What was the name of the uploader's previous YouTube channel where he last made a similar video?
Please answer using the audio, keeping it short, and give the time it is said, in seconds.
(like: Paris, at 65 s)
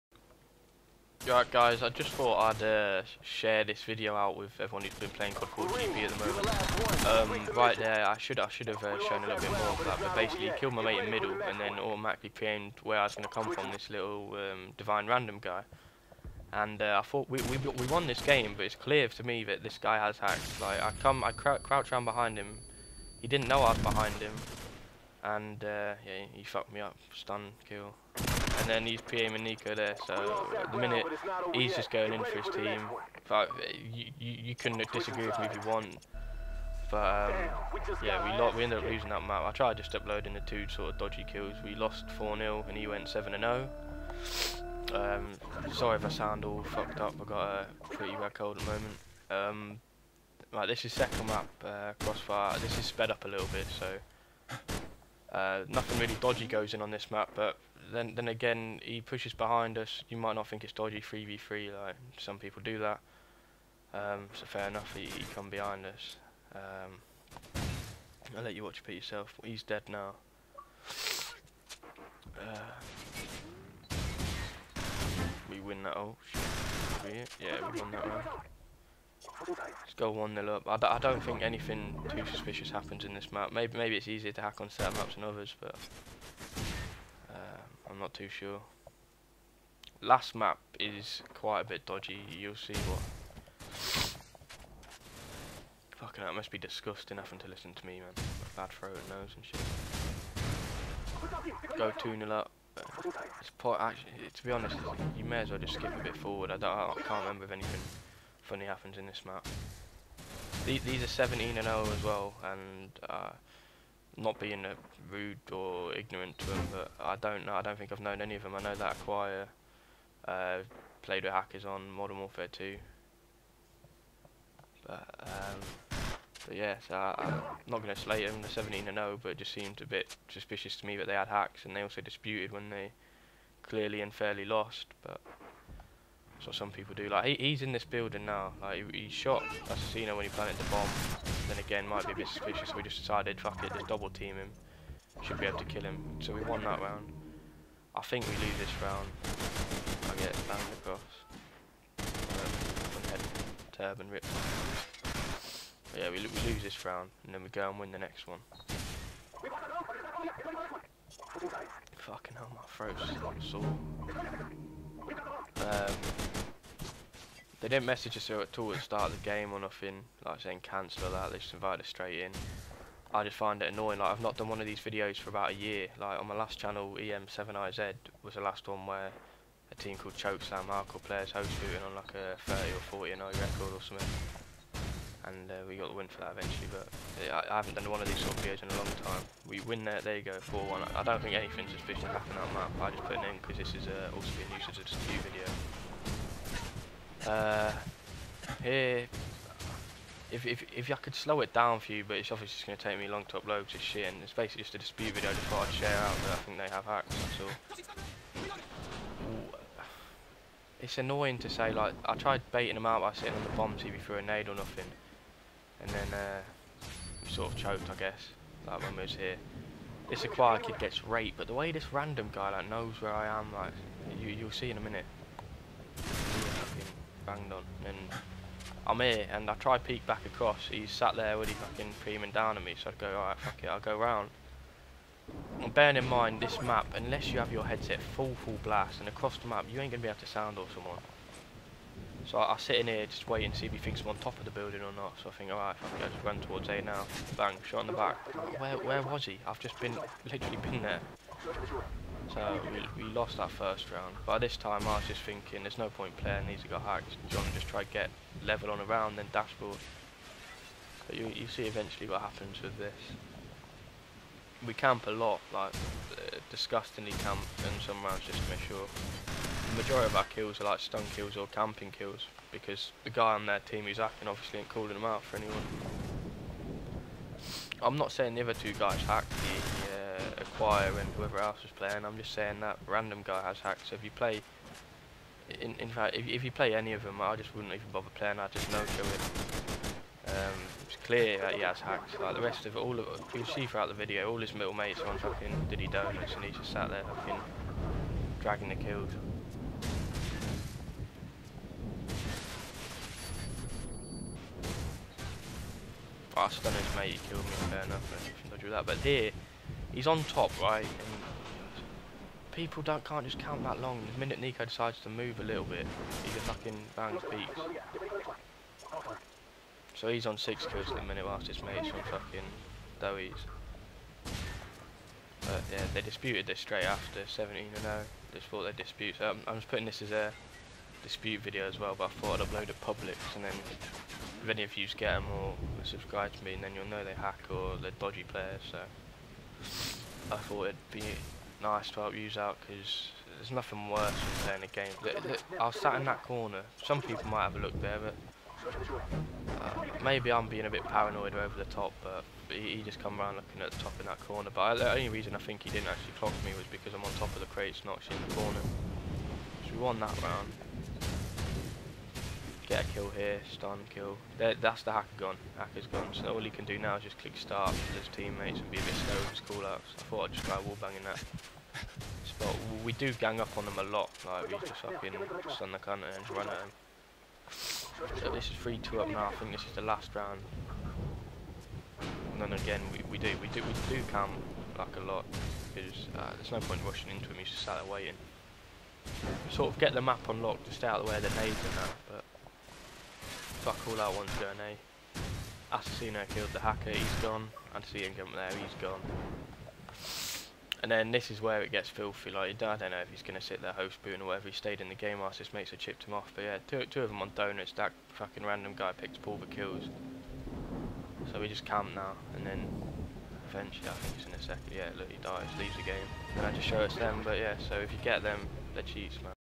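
EM7IZ, at 176 s.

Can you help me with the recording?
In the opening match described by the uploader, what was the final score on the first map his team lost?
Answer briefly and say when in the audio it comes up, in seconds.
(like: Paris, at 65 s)
4-0, at 41 s.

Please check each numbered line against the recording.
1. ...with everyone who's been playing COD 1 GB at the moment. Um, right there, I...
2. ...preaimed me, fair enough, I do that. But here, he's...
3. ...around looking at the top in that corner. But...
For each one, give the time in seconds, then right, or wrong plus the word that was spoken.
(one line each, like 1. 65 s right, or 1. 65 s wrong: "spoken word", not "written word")
1. 4 s wrong: "4", not "1"
2. 307 s wrong: "killed", not "preaimed"
3. 353 s right.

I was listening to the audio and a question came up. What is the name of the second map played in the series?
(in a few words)
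Crossfire.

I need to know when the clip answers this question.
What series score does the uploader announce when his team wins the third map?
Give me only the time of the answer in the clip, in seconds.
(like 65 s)
190 s.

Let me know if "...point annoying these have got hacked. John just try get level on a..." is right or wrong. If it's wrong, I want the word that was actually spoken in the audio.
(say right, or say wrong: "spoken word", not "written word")
wrong: "playing", not "annoying".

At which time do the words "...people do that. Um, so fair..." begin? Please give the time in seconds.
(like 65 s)
62 s.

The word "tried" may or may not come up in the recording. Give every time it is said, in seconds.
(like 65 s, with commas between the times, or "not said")
39 s, 212 s.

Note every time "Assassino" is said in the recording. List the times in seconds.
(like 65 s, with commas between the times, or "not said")
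139 s, 395 s.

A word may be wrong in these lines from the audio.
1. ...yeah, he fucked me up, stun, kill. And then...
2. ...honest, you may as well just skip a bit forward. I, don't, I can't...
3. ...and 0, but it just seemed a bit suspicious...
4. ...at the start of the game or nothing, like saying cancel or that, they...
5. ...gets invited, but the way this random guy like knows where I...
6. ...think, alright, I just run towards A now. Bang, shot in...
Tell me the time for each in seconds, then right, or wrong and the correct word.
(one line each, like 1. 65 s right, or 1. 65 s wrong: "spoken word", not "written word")
1. 26 s right
2. 104 s right
3. 128 s right
4. 168 s right
5. 220 s wrong: "raped", not "invited"
6. 245 s right.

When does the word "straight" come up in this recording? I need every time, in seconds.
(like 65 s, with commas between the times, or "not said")
171 s, 326 s.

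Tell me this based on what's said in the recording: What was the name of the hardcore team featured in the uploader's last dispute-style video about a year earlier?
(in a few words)
Chokeslam.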